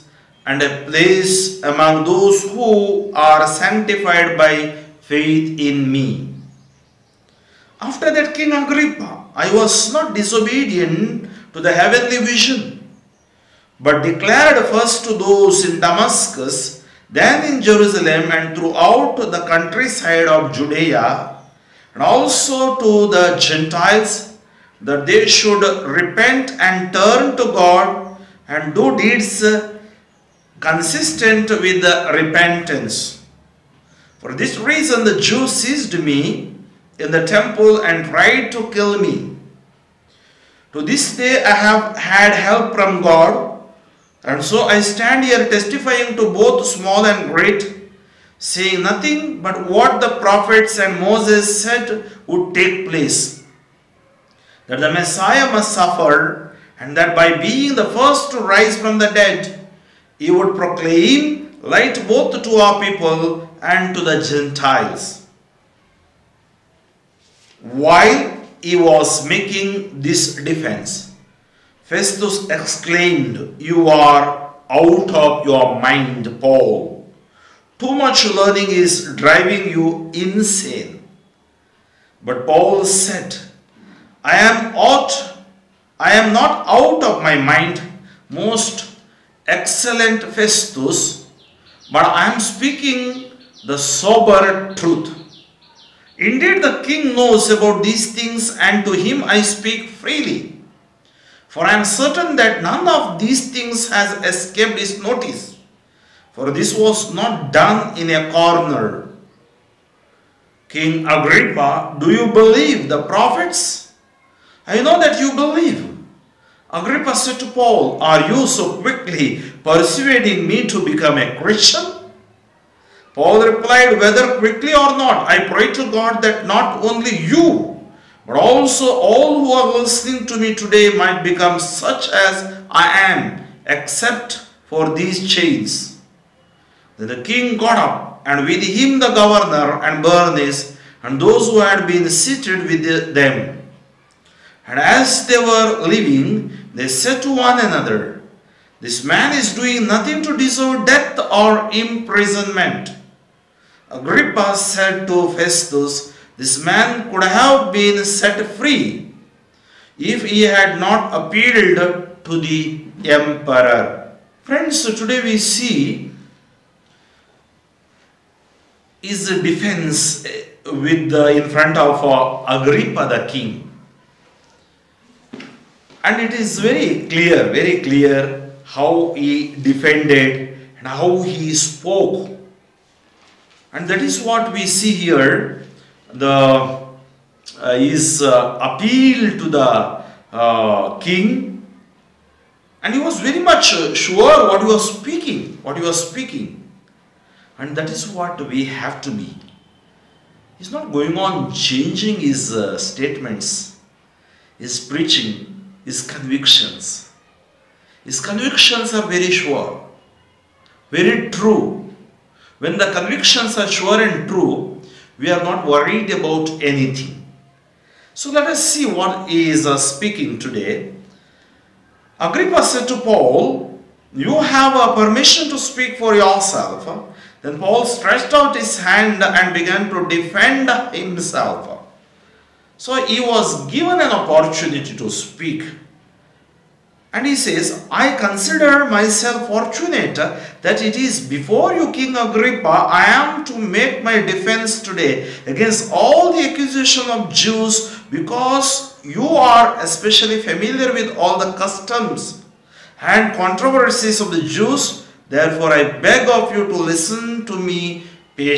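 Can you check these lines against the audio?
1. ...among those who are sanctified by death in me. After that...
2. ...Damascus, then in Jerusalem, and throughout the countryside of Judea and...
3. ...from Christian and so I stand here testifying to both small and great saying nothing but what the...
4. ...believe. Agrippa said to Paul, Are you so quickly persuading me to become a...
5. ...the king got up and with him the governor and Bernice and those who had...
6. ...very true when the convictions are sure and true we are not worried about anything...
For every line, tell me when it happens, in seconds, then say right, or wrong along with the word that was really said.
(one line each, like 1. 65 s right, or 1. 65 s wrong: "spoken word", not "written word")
1. 1 s wrong: "faith", not "death"
2. 15 s right
3. 42 s wrong: "God", not "Christian"
4. 115 s right
5. 137 s right
6. 210 s right.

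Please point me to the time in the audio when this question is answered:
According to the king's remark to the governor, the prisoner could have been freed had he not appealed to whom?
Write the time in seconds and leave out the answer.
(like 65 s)
162 s.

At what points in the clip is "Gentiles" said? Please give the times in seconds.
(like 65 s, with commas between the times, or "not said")
23 s, 64 s.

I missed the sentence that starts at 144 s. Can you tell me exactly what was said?
And as they were leaving, they said to one another, This man is doing nothing to deserve death or imprisonment.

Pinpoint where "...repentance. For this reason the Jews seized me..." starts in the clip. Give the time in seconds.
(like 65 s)
32 s.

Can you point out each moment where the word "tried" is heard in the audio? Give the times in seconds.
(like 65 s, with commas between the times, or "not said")
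38 s.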